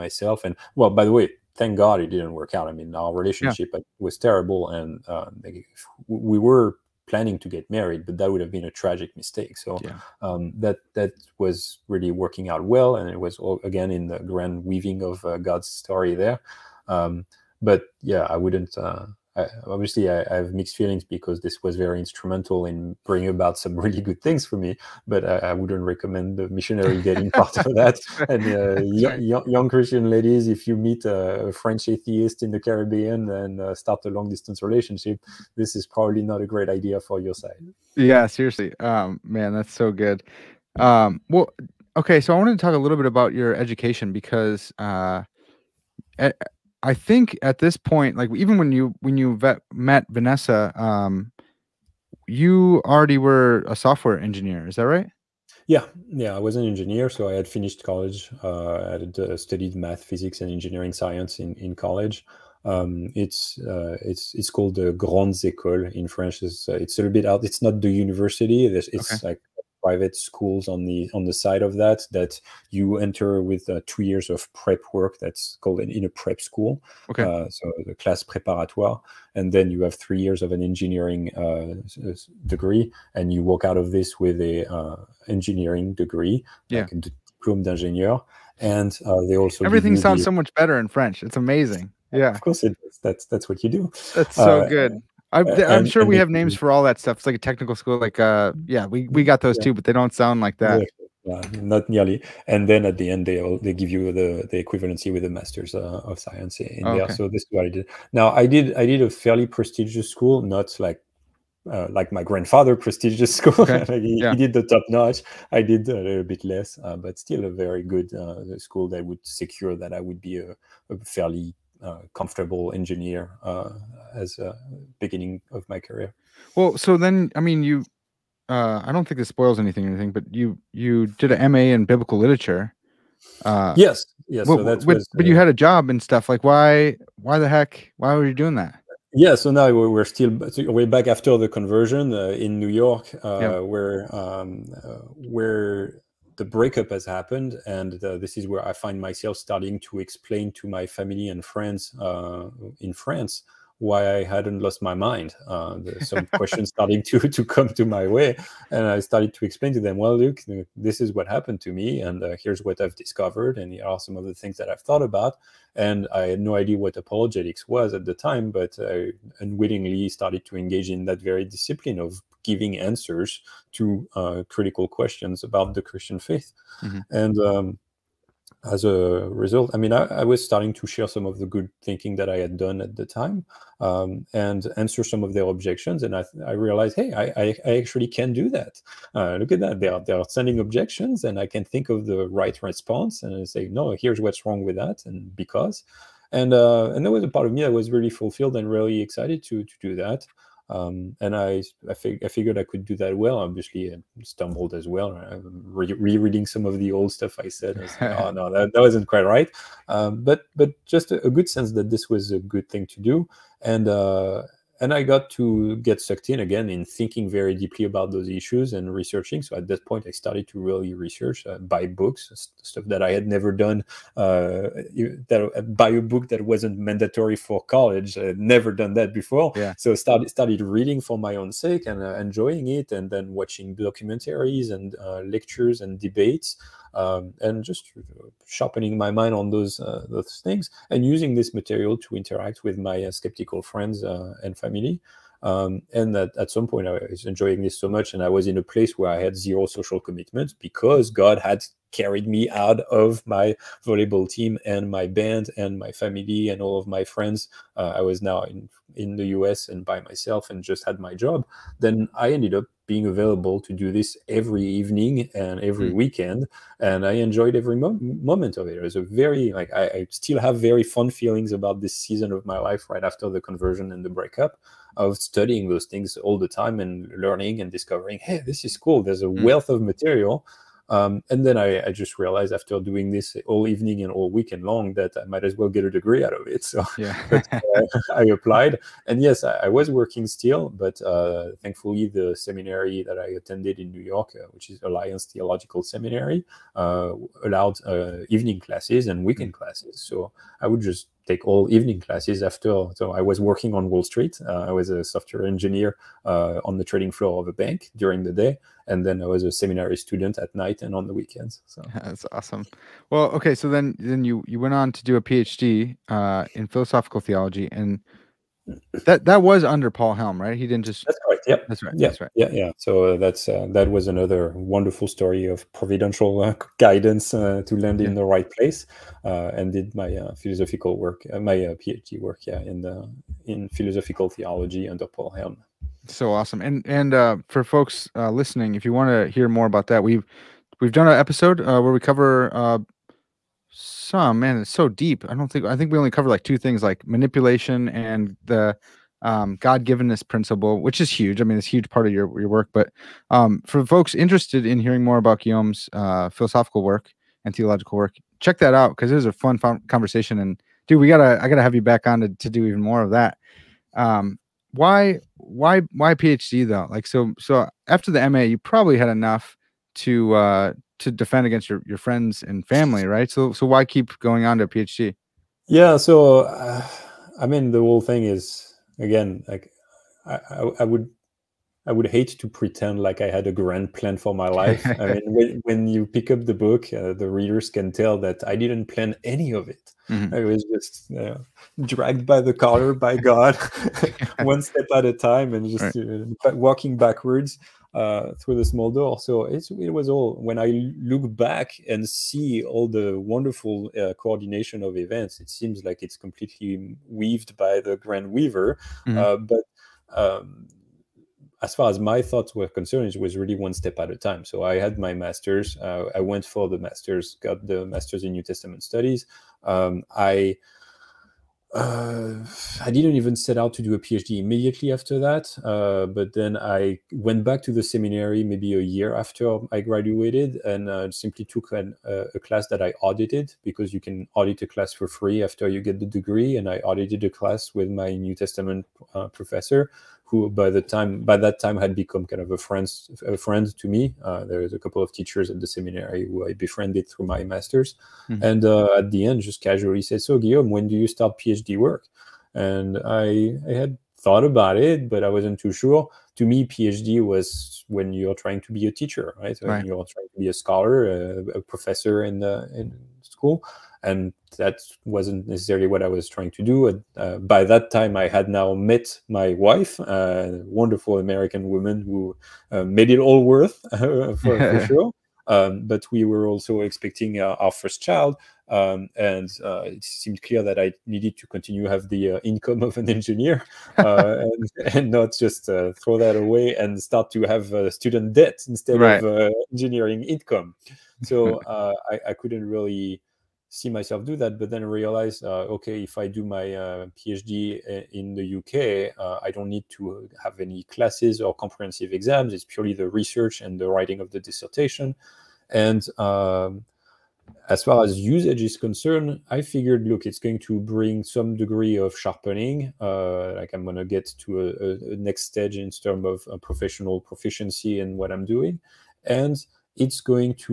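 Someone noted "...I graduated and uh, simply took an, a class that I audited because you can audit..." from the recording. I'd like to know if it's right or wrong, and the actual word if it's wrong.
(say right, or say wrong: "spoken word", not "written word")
right.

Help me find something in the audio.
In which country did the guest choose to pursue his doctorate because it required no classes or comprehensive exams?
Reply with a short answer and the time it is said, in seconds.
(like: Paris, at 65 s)
UK, at 498 s.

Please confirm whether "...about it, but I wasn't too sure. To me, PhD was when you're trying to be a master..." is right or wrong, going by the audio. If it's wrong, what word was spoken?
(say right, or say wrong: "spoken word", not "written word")
wrong: "teacher", not "master".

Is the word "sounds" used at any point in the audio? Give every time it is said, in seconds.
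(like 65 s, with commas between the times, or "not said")
89 s, 100 s.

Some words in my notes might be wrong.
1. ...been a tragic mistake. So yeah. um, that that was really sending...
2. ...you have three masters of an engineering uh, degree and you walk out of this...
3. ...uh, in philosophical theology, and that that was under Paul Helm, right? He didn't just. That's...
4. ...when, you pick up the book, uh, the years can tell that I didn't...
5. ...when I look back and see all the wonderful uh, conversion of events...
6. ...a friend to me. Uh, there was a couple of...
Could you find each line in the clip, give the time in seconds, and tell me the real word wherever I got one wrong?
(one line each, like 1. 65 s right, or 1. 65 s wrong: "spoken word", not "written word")
1. 8 s wrong: "working", not "sending"
2. 79 s wrong: "years", not "masters"
3. 316 s right
4. 385 s wrong: "readers", not "years"
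5. 400 s wrong: "coordination", not "conversion"
6. 443 s right.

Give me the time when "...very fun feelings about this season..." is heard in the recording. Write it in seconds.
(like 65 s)
270 s.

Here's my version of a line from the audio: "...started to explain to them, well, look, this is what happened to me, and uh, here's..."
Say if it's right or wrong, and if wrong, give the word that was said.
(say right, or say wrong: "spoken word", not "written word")
right.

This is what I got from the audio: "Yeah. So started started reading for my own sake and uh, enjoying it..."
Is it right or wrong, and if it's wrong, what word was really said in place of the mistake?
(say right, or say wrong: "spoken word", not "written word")
right.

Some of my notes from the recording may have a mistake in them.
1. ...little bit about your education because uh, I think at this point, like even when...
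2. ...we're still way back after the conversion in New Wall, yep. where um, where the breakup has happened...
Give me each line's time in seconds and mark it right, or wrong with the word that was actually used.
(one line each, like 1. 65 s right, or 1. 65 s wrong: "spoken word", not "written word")
1. 42 s right
2. 139 s wrong: "York", not "Wall".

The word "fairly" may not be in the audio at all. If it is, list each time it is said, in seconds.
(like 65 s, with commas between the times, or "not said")
109 s, 121 s.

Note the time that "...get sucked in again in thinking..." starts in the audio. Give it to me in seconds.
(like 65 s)
215 s.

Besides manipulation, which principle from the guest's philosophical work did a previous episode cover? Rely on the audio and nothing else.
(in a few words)
God-givenness principle.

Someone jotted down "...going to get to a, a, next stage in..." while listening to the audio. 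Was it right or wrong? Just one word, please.
right.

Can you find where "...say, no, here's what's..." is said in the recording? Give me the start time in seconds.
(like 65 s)
193 s.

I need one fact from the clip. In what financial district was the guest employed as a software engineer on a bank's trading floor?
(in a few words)
Wall Street.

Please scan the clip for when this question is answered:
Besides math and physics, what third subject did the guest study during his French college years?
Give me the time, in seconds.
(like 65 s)
60 s.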